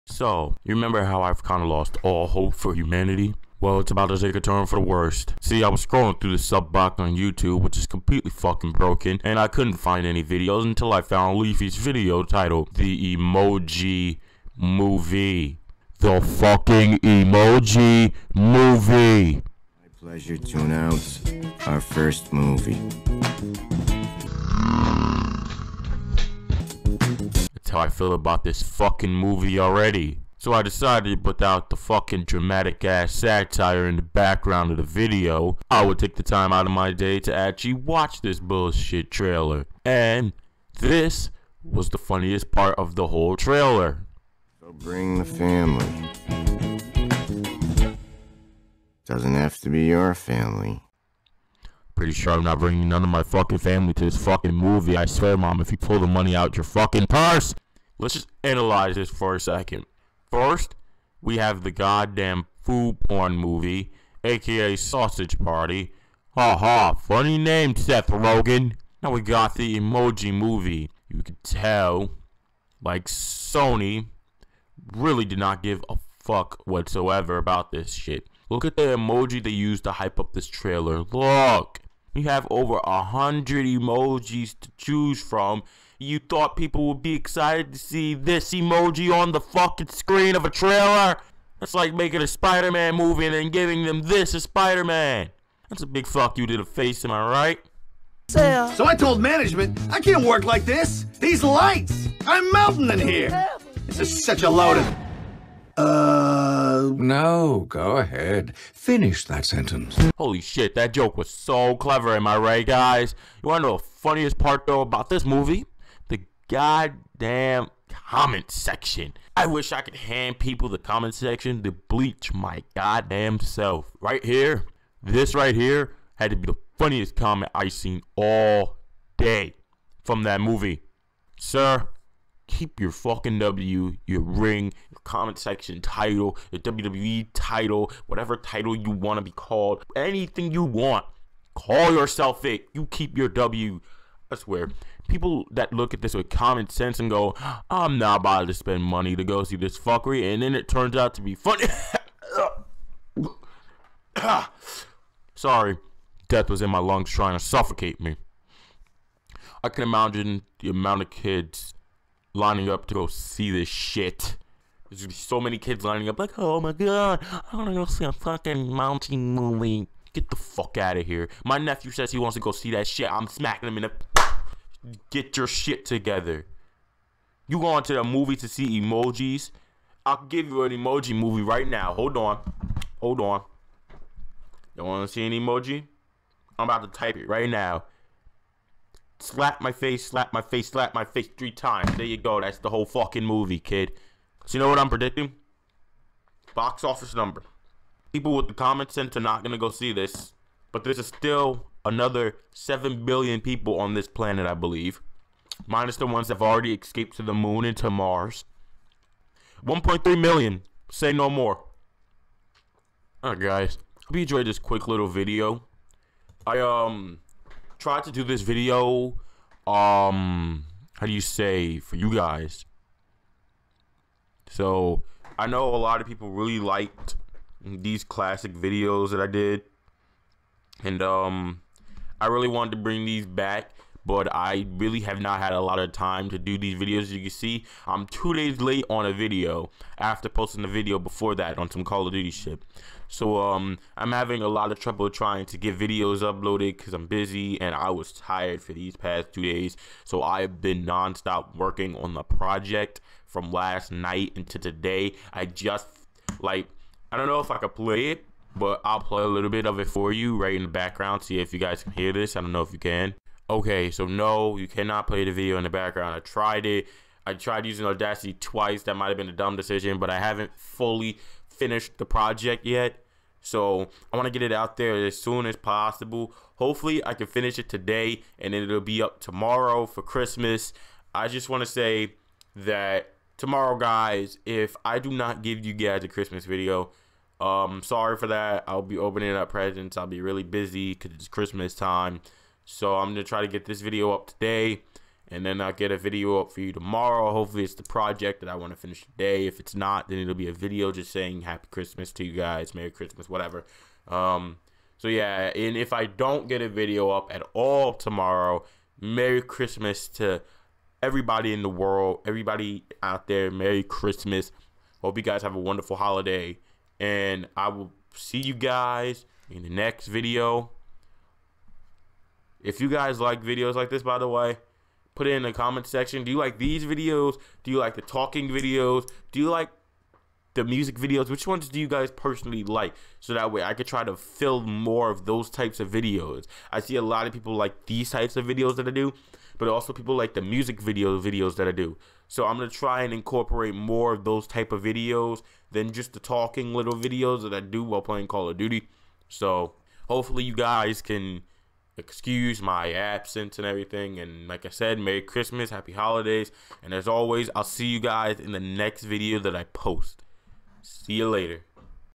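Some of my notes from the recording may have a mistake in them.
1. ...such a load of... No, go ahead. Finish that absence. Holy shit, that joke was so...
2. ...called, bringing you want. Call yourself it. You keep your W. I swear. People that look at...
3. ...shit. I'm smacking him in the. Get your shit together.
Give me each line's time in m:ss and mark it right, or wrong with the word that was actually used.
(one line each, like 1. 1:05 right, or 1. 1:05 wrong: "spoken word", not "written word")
1. 1:44 wrong: "sentence", not "absence"
2. 2:19 wrong: "anything", not "bringing"
3. 2:52 right.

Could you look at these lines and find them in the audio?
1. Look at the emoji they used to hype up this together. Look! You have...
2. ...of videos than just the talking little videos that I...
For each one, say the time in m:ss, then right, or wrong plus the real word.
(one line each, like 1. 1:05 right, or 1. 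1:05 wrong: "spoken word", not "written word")
1. 1:18 wrong: "trailer", not "together"
2. 5:44 right.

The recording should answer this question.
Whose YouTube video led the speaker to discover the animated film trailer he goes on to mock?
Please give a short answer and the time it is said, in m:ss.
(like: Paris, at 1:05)
Leafy, at 0:11.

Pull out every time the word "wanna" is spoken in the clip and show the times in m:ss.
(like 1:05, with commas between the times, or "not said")
1:53, 2:47, 3:04.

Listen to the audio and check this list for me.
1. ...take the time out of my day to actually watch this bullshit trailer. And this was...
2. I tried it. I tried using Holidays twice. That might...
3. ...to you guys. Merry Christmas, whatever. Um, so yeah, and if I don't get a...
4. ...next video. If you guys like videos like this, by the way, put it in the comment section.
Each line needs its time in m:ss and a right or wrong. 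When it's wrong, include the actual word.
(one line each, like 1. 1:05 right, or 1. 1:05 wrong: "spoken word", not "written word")
1. 0:35 right
2. 4:26 wrong: "Audacity", not "Holidays"
3. 5:02 right
4. 5:19 right.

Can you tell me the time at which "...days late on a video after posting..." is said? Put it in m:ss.
3:58.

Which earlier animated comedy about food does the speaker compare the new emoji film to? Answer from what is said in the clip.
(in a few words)
Sausage Party.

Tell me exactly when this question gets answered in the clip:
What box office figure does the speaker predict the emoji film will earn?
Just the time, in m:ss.
3:29.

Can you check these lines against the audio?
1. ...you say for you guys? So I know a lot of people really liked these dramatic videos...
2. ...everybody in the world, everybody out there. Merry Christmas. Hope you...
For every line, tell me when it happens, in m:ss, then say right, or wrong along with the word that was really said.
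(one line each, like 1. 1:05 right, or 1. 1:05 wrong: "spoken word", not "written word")
1. 3:41 wrong: "classic", not "dramatic"
2. 5:11 right.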